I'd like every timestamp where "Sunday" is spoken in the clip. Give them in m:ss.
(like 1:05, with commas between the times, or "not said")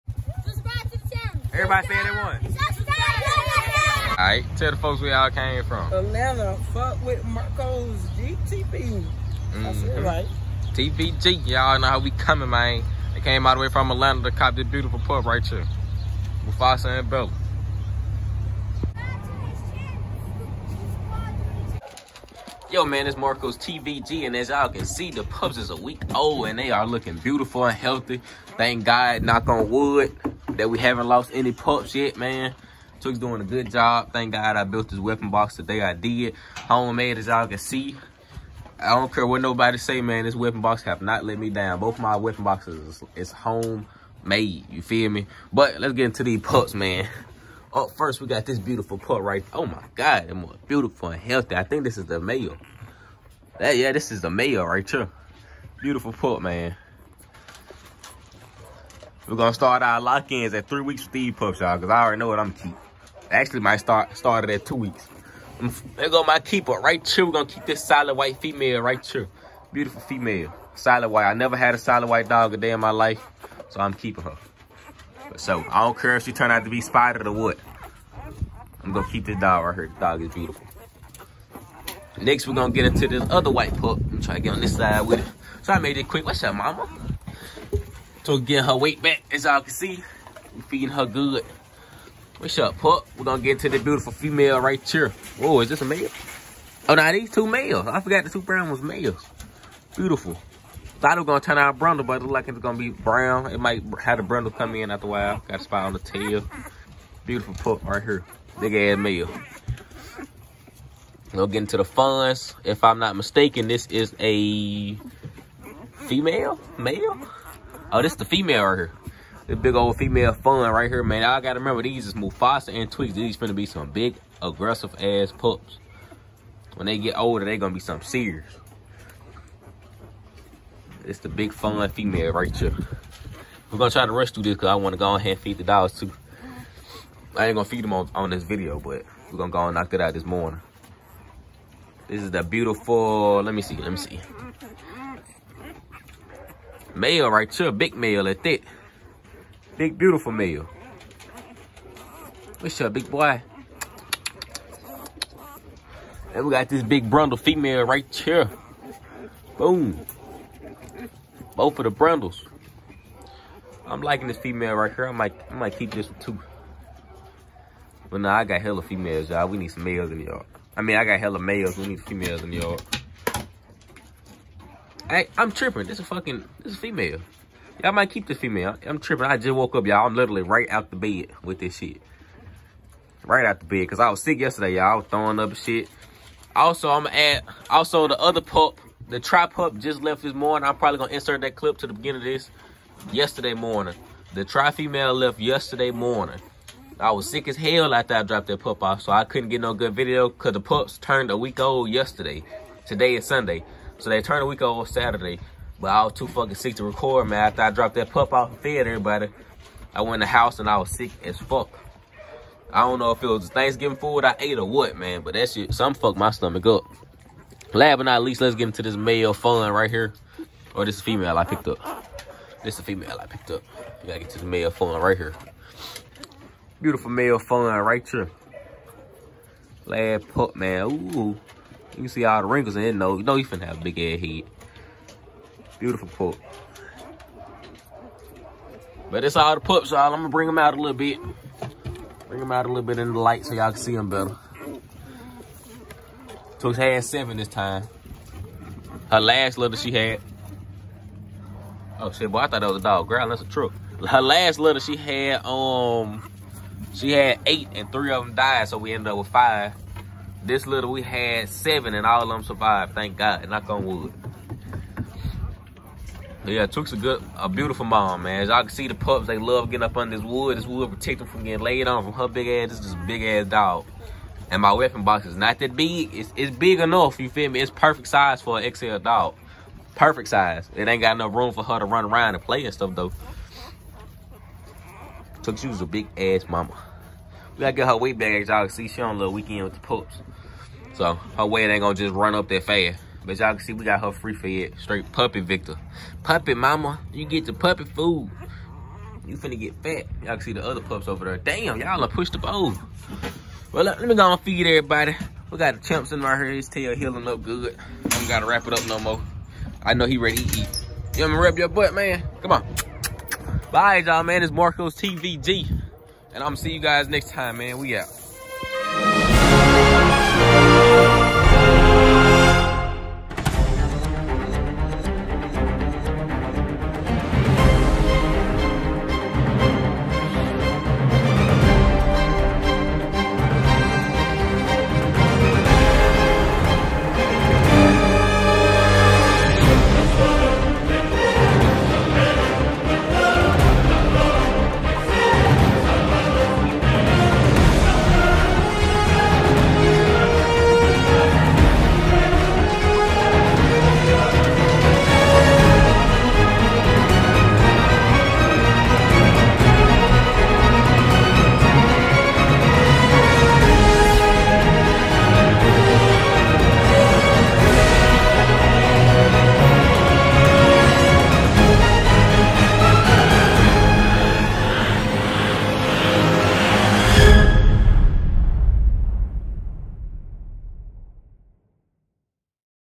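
3:23.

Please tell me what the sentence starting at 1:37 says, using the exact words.
I forgot the two brown ones males.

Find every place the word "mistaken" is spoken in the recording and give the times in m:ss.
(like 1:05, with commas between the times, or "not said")
1:53.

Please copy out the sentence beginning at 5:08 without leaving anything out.
I don't gotta wrap it up no more.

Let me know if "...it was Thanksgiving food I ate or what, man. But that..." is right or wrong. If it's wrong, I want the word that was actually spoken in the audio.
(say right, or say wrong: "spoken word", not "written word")
right.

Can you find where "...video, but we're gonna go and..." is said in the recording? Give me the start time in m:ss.
2:18.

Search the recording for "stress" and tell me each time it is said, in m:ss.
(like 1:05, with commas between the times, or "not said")
not said.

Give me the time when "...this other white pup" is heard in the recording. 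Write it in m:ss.
1:23.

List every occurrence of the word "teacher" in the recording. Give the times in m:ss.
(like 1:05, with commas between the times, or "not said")
not said.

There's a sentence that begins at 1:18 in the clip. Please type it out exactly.
I'm gonna keep this dog right here.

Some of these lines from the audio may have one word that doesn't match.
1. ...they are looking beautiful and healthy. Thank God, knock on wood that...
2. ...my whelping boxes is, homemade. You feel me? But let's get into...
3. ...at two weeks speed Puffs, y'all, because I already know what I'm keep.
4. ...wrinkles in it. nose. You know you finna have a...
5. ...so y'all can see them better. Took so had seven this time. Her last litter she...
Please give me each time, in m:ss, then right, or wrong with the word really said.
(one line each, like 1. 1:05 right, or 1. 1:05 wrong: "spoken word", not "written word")
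1. 0:26 right
2. 0:41 right
3. 1:00 wrong: "three", not "two"
4. 3:52 right
5. 4:03 right.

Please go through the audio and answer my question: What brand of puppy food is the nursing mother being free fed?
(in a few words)
Victor.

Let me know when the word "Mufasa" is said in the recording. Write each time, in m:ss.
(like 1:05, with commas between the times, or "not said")
0:16, 2:02.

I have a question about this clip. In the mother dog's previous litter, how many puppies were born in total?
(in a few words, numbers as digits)
8.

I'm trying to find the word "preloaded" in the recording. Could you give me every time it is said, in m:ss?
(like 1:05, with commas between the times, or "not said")
not said.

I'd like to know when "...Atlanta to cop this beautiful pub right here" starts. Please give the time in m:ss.
0:13.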